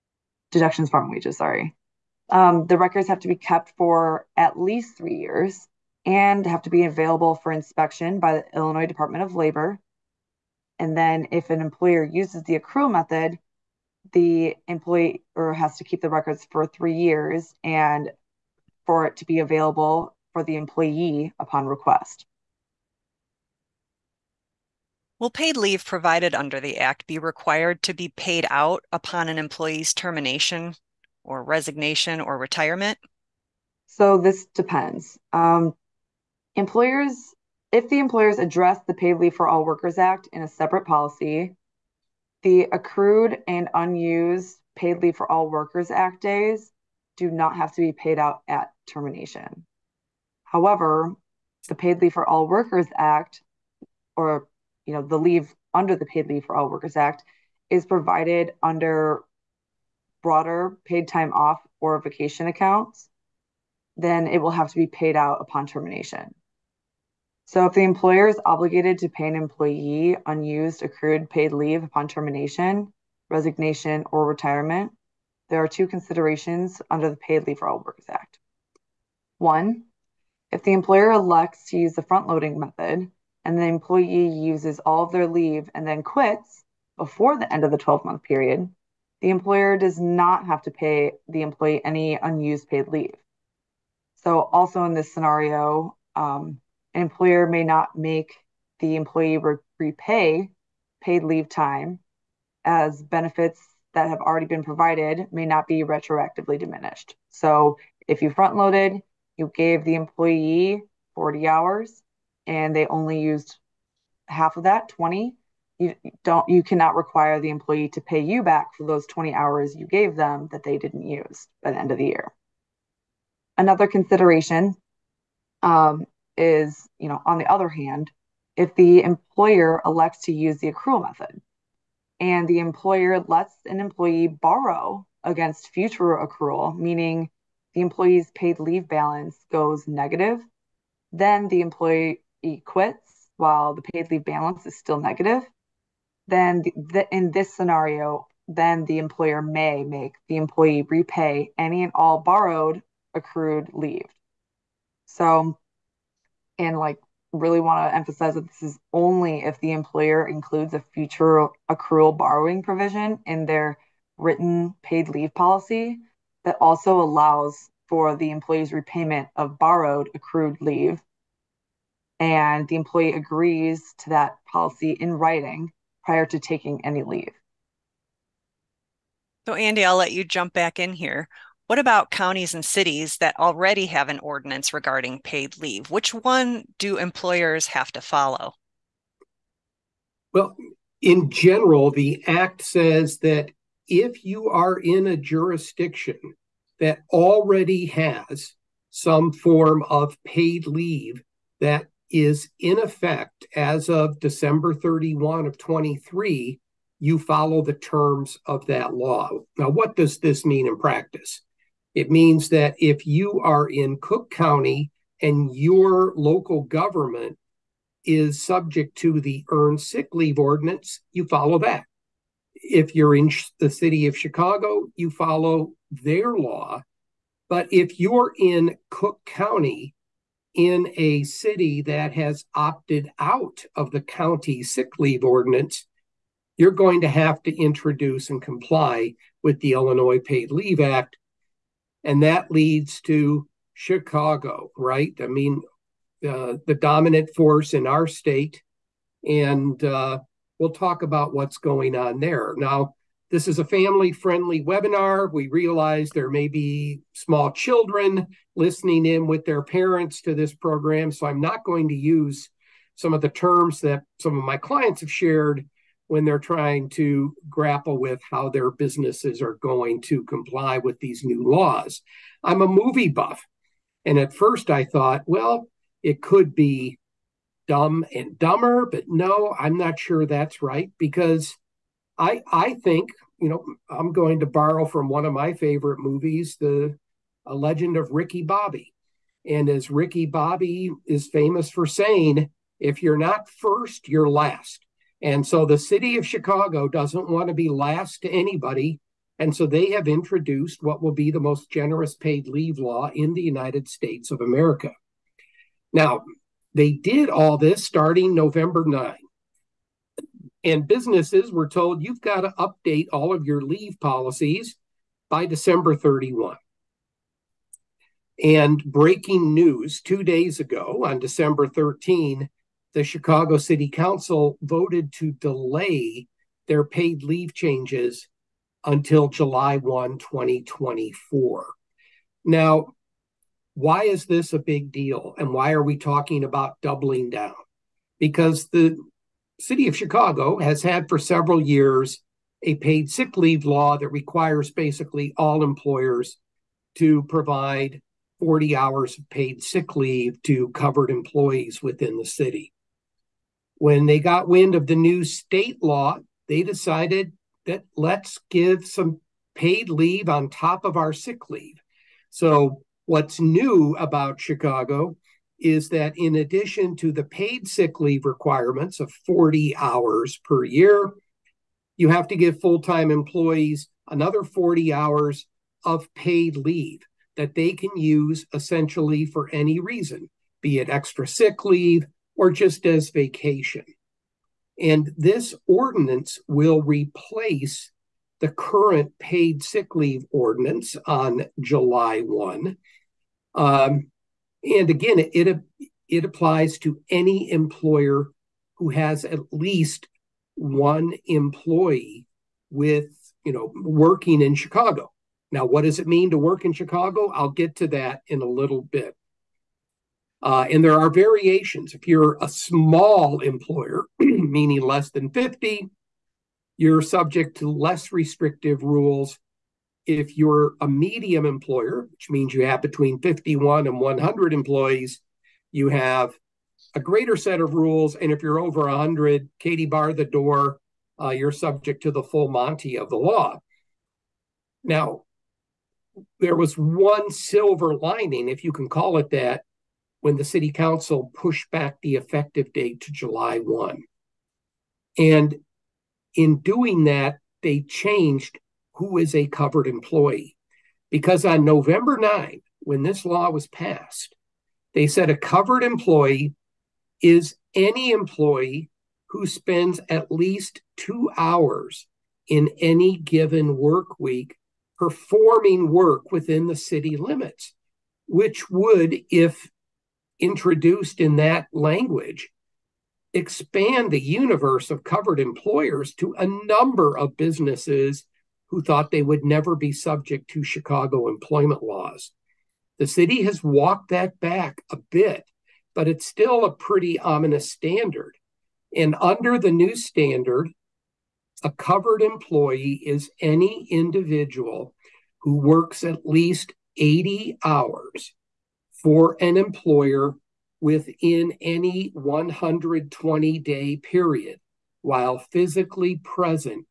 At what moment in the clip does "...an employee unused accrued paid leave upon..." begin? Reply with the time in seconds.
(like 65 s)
69 s.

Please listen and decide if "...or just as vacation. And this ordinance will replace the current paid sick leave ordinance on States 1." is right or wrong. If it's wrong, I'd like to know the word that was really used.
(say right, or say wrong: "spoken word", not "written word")
wrong: "July", not "States".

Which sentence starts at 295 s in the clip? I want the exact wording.
And so the city of Chicago doesn't want to be last to anybody.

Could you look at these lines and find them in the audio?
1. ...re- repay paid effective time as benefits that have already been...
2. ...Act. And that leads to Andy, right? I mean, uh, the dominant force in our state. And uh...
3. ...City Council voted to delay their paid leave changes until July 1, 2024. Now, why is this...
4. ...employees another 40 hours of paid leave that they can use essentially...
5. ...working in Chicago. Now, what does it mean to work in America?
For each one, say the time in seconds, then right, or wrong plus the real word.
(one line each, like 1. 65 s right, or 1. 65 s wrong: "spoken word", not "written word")
1. 99 s wrong: "leave", not "effective"
2. 240 s wrong: "Chicago", not "Andy"
3. 323 s right
4. 373 s right
5. 403 s wrong: "Chicago", not "America".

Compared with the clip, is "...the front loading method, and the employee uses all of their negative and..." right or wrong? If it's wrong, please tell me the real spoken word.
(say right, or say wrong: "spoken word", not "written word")
wrong: "leave", not "negative".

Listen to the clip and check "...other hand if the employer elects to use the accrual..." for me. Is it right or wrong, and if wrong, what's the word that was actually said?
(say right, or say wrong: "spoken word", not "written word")
right.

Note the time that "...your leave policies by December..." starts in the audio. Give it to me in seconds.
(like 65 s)
313 s.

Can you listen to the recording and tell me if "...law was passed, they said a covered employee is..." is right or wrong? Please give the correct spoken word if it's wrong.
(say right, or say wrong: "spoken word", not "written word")
right.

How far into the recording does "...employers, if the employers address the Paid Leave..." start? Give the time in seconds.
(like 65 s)
36 s.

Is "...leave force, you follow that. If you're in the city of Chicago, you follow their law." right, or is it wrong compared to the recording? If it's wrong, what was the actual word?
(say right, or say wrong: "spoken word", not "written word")
wrong: "ordinance", not "force".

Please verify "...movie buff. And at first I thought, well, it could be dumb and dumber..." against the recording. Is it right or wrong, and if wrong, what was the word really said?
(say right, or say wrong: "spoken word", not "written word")
right.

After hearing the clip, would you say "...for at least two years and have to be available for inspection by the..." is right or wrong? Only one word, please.
wrong.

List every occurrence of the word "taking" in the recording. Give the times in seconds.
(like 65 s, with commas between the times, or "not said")
176 s.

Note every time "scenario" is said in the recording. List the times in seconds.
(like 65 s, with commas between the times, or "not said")
95 s, 147 s.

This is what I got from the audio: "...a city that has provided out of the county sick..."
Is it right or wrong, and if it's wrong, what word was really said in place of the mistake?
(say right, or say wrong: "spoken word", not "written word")
wrong: "opted", not "provided".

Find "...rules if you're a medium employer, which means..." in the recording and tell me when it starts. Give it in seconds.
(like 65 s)
418 s.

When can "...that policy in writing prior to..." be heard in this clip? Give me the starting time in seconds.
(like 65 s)
174 s.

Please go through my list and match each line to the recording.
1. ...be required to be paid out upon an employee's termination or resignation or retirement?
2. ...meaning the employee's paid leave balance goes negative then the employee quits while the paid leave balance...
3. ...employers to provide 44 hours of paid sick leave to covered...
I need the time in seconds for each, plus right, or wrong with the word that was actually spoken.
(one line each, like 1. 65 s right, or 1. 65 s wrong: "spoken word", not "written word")
1. 27 s right
2. 136 s right
3. 345 s wrong: "40", not "44".